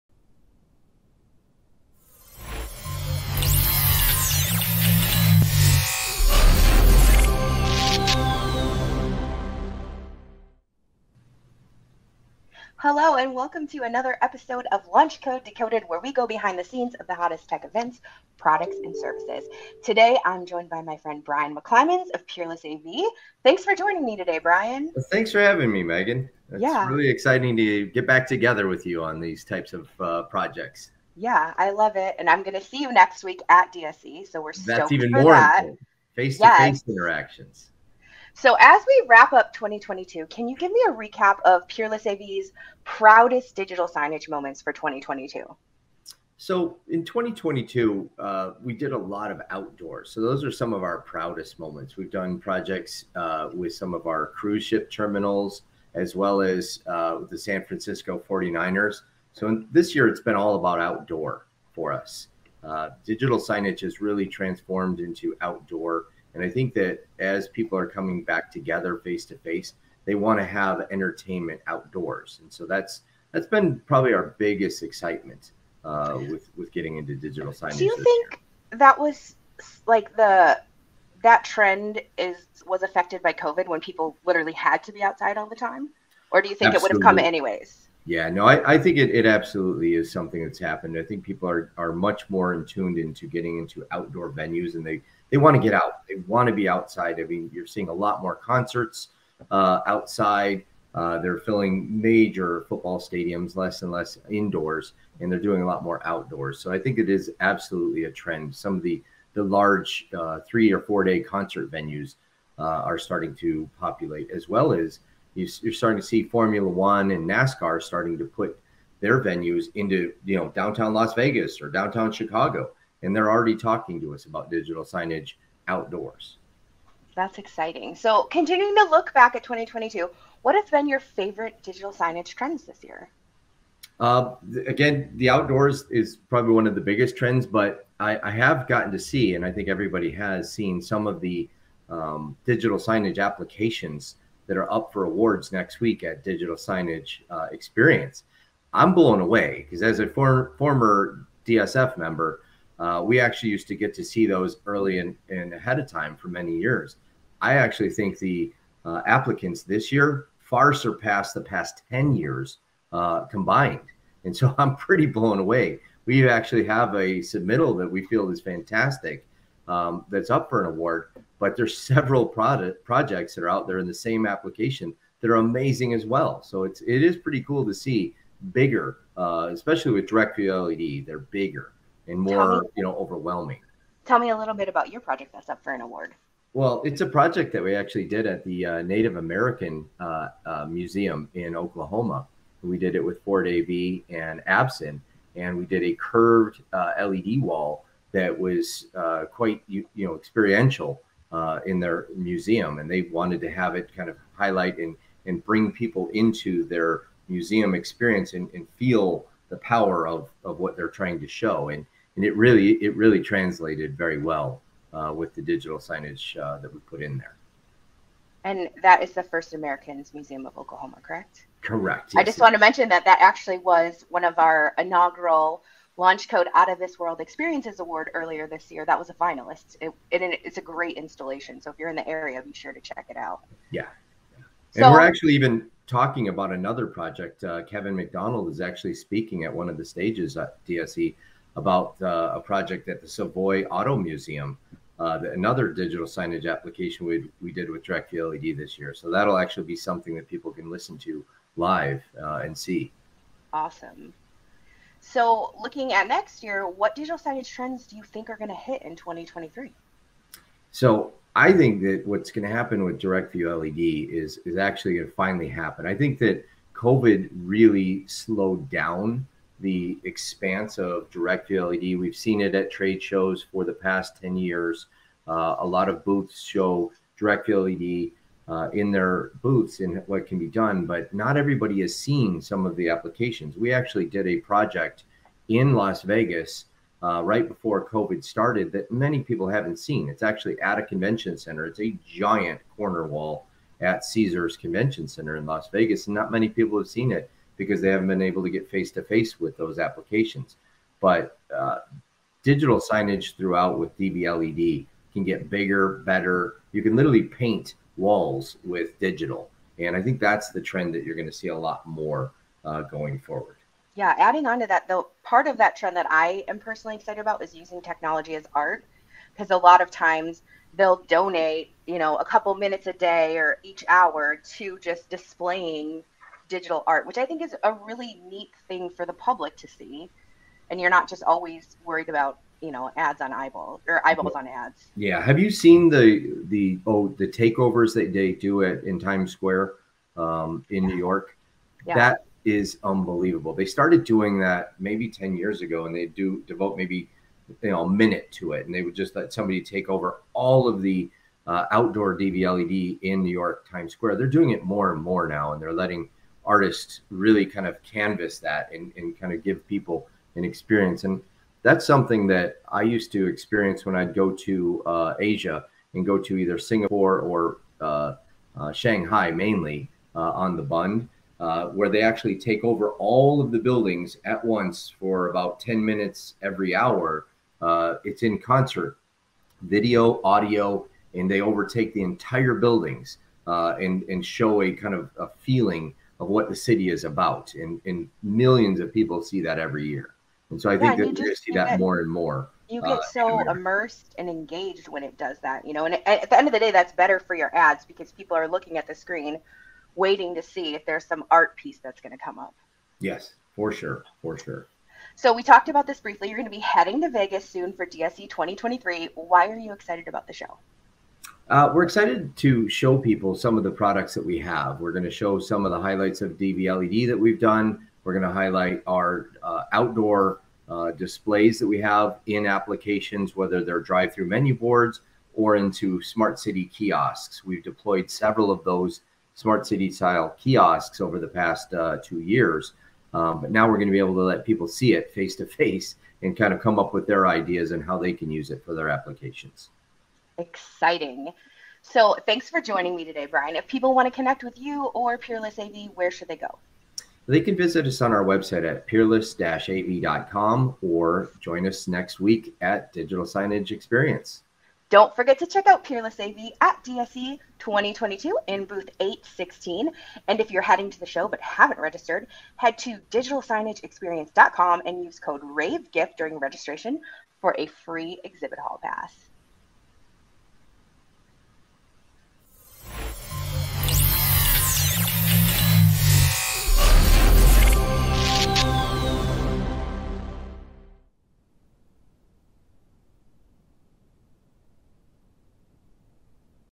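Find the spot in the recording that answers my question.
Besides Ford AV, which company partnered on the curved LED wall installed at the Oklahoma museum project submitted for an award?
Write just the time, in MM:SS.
03:14.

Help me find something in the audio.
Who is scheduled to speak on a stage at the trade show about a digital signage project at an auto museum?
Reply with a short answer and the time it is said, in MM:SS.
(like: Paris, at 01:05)
Kevin McDonald, at 03:57.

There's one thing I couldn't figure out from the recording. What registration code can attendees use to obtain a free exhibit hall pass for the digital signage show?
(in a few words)
RAVEGIFT.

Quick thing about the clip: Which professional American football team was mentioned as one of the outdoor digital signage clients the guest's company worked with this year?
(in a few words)
San Francisco 49ers.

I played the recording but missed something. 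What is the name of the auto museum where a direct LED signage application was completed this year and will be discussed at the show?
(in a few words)
Savoy Auto Museum.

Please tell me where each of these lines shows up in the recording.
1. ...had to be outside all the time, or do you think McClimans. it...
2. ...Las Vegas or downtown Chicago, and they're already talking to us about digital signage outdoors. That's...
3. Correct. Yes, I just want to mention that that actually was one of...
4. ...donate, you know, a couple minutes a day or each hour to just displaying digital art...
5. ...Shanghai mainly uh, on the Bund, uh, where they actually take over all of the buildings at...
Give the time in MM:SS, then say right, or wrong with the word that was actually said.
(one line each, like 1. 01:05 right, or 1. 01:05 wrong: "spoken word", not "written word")
1. 01:24 wrong: "Absolutely", not "McClimans"
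2. 02:00 right
3. 03:41 right
4. 05:21 right
5. 06:08 right.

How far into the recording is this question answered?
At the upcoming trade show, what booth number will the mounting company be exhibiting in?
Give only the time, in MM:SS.
07:38.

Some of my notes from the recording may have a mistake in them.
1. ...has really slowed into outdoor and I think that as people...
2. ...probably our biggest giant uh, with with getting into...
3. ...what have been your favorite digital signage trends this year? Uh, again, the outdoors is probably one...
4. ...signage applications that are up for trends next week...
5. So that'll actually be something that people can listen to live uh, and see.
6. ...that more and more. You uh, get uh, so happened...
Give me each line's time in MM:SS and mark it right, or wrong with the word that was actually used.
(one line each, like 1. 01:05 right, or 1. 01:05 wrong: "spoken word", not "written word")
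1. 01:03 wrong: "transformed", not "slowed"
2. 01:13 wrong: "excitement", not "giant"
3. 02:10 right
4. 02:22 wrong: "awards", not "trends"
5. 04:08 right
6. 06:31 wrong: "immersed", not "happened".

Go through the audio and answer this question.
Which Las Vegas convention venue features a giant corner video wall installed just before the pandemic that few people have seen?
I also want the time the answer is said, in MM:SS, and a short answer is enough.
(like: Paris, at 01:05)
Caesars Convention Center, at 04:54.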